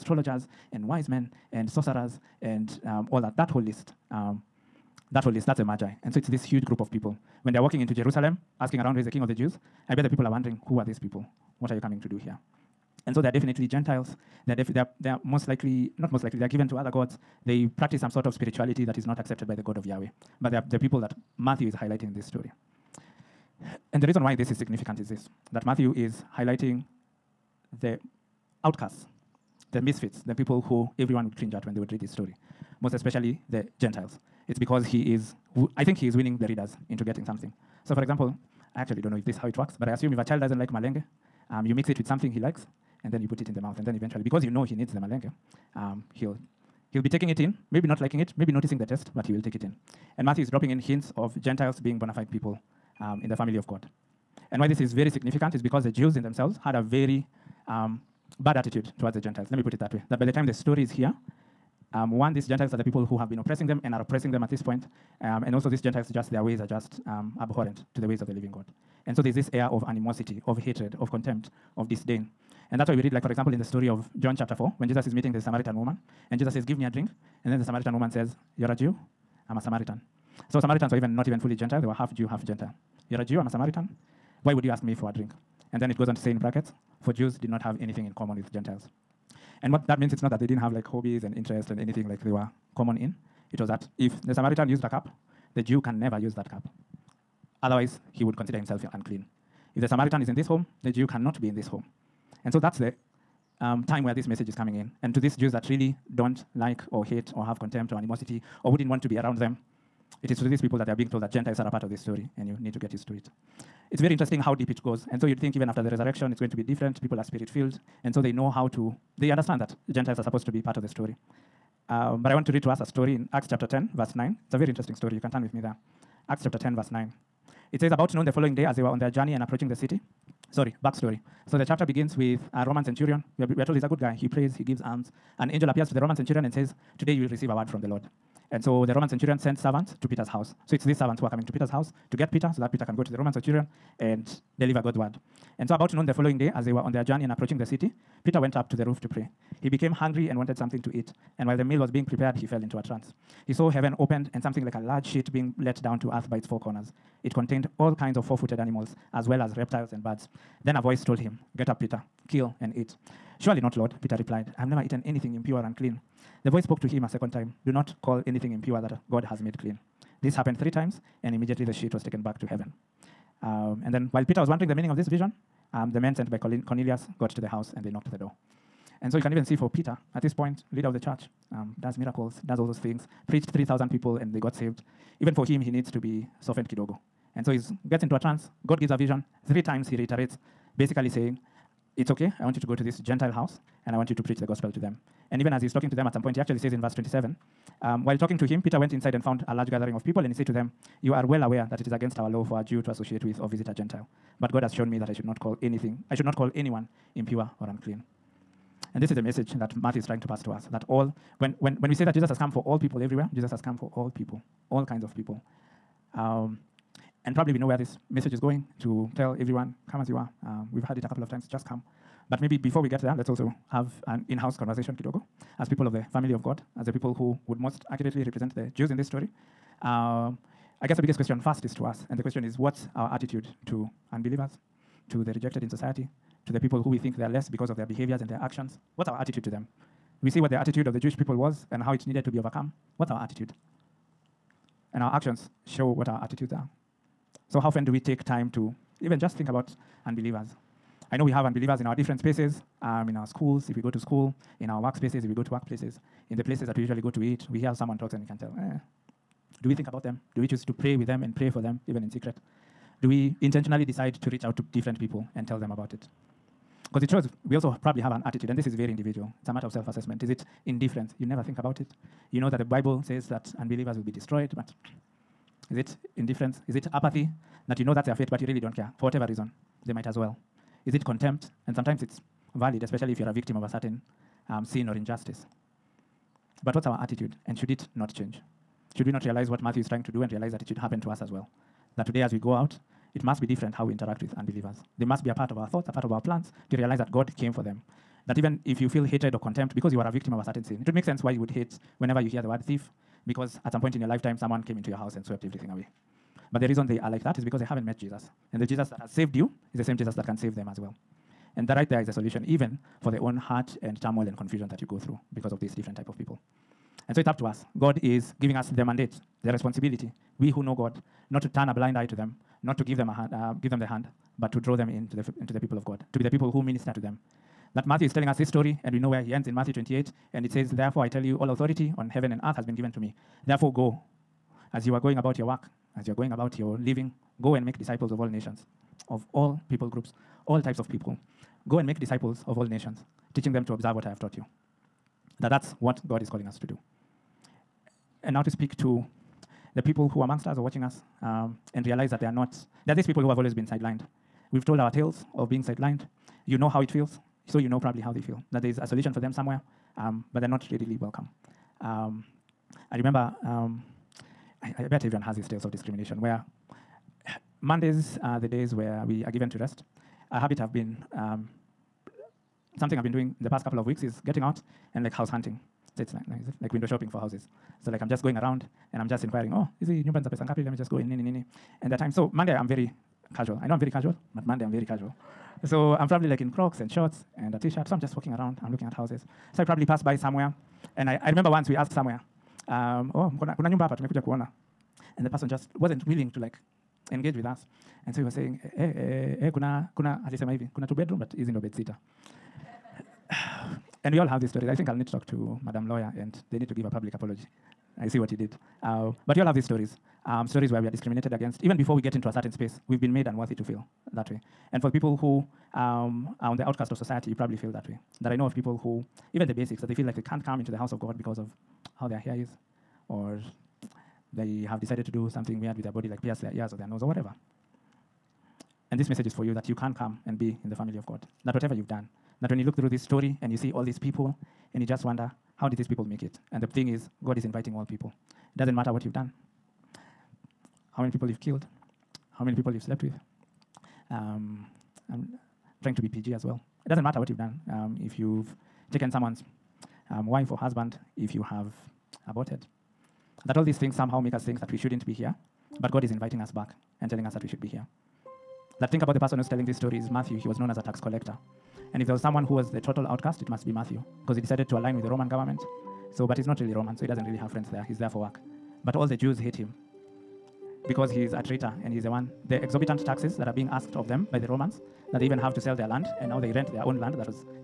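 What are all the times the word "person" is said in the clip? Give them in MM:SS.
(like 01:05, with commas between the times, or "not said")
06:35, 07:39.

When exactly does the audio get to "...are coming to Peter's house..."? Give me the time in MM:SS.
02:21.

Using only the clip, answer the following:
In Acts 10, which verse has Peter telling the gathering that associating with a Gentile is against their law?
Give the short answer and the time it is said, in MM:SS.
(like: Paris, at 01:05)
27, at 03:16.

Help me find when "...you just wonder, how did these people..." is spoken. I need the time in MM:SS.
07:14.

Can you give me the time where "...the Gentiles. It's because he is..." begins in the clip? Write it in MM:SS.
00:33.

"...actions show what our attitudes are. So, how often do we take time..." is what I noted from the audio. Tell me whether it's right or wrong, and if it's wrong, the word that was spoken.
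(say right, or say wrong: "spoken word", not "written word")
right.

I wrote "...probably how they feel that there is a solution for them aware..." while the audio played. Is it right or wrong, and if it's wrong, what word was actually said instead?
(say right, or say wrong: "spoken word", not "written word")
wrong: "somewhere", not "aware".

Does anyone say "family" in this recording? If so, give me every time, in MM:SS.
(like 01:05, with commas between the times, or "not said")
00:53, 03:46, 07:10.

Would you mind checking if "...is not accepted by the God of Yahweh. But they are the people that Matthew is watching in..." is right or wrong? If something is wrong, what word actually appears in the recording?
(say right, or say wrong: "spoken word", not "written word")
wrong: "highlighting", not "watching".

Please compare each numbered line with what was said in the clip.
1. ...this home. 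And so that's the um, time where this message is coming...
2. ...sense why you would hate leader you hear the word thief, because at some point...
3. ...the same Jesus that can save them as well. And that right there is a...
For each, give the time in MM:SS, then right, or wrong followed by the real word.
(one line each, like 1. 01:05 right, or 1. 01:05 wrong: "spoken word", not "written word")
1. 01:41 right
2. 05:01 wrong: "whenever", not "leader"
3. 05:09 right.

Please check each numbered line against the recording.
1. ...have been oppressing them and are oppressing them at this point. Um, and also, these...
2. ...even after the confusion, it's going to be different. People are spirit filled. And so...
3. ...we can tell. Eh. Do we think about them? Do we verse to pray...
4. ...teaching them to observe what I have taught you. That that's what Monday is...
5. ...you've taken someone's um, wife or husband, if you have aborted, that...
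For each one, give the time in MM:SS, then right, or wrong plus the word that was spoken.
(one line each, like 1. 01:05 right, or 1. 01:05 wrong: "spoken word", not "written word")
1. 01:03 right
2. 01:55 wrong: "resurrection", not "confusion"
3. 04:18 wrong: "choose", not "verse"
4. 05:43 wrong: "God", not "Monday"
5. 07:28 right.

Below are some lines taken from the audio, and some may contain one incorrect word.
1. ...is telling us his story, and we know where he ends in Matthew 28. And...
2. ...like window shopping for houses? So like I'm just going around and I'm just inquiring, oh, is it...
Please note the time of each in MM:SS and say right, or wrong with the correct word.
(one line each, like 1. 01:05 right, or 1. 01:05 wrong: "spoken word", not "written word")
1. 05:28 right
2. 06:16 right.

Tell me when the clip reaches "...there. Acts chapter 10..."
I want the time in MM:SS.
02:05.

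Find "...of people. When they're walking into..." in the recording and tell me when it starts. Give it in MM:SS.
00:06.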